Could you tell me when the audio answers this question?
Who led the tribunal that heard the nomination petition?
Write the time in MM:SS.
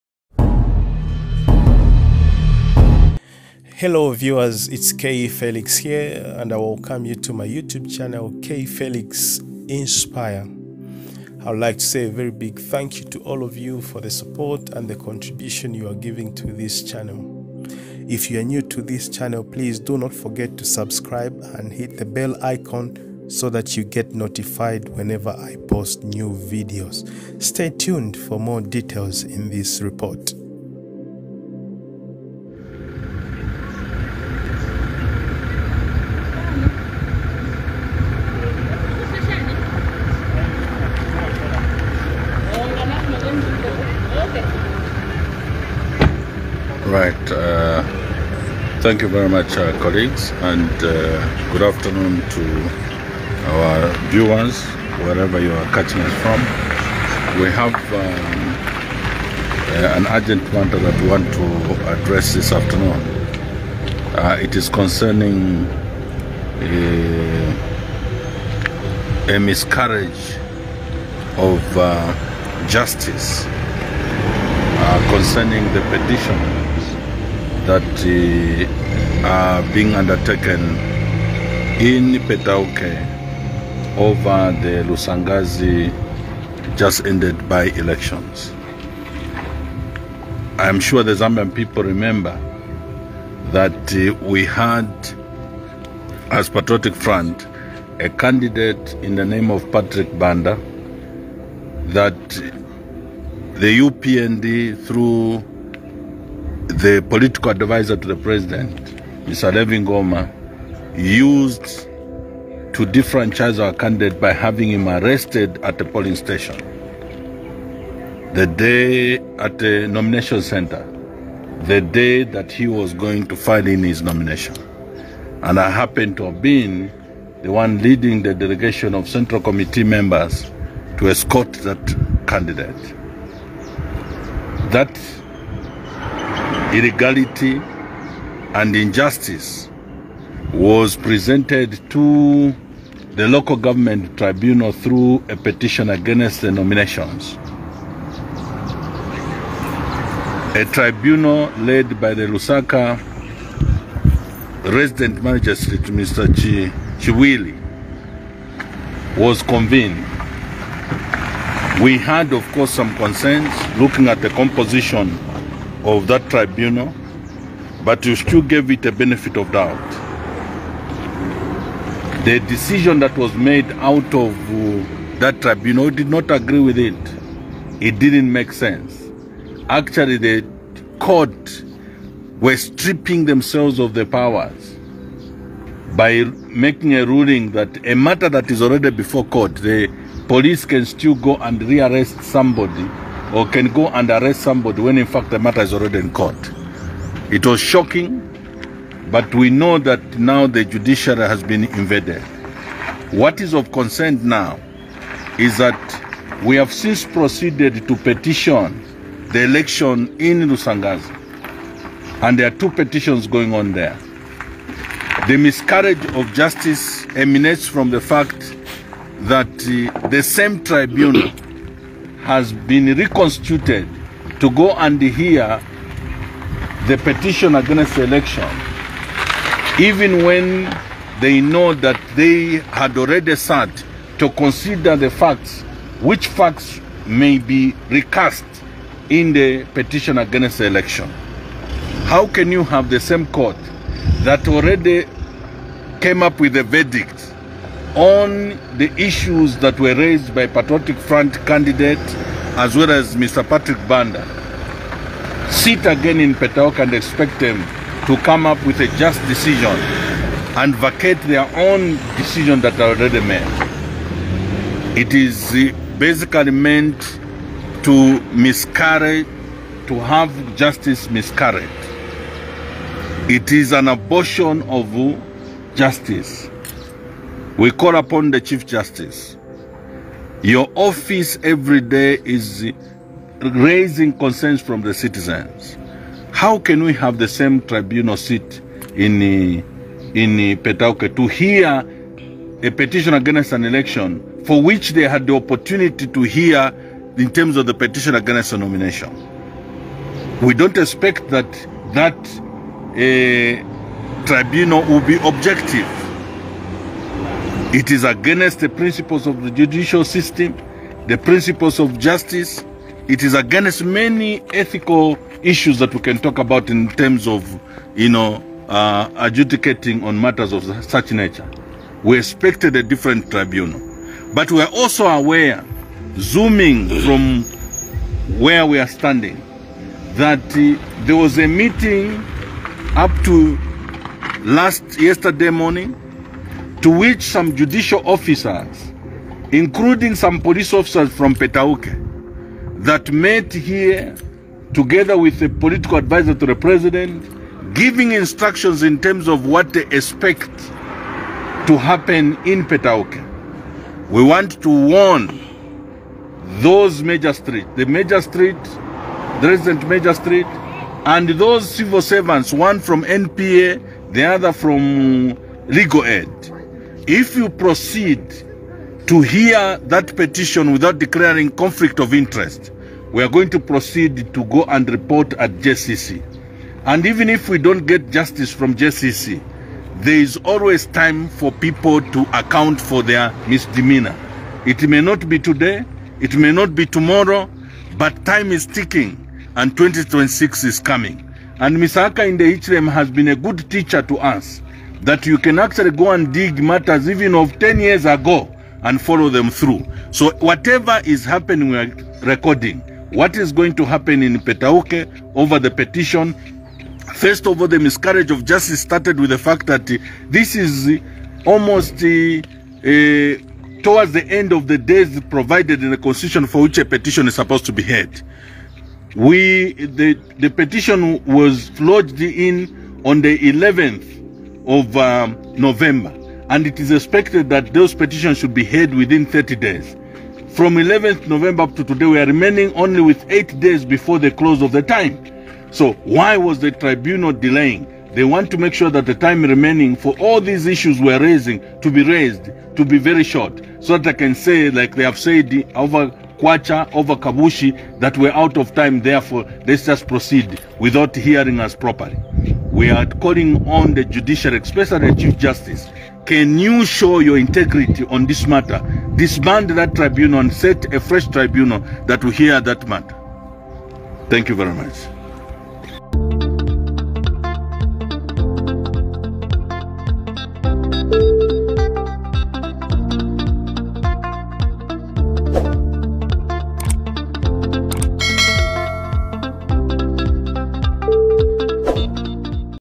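02:32.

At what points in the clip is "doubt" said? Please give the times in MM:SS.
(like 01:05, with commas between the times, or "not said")
02:49.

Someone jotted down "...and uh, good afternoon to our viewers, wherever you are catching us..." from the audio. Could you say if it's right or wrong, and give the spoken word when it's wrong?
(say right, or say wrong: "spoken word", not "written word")
right.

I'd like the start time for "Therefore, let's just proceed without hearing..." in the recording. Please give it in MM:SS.
07:29.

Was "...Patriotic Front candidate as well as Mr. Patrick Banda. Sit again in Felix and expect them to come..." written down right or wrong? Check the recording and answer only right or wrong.
wrong.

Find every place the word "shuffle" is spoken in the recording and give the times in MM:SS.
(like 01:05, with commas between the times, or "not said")
not said.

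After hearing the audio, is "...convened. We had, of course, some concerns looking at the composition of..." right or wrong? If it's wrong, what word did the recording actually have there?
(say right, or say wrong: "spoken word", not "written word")
right.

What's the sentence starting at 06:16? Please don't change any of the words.
And even if we don't get justice from JCC, there is always time for people to account for their misdemeanor.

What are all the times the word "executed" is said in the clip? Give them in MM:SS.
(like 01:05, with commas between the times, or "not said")
not said.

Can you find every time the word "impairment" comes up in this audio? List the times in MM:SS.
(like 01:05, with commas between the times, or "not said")
not said.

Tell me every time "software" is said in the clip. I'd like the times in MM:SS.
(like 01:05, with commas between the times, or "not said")
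not said.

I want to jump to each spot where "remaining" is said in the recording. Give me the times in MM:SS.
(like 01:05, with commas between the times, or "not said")
07:12, 07:19.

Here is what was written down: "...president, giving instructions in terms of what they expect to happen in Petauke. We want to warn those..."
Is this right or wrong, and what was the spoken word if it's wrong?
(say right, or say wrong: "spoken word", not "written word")
right.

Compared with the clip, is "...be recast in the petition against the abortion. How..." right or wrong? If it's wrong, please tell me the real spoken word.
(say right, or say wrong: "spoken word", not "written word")
wrong: "election", not "abortion".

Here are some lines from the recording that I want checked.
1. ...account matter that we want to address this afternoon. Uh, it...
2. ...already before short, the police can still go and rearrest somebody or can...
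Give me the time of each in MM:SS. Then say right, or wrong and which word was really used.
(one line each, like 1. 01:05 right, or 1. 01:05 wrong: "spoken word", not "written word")
1. 01:00 wrong: "urgent", not "account"
2. 03:08 wrong: "court", not "short".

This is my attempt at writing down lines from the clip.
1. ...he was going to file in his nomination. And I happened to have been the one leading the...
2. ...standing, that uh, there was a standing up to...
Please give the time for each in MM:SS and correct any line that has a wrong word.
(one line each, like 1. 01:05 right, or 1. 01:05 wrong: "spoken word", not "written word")
1. 02:02 right
2. 05:28 wrong: "meeting", not "standing".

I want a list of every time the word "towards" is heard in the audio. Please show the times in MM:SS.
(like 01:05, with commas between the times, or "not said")
06:53.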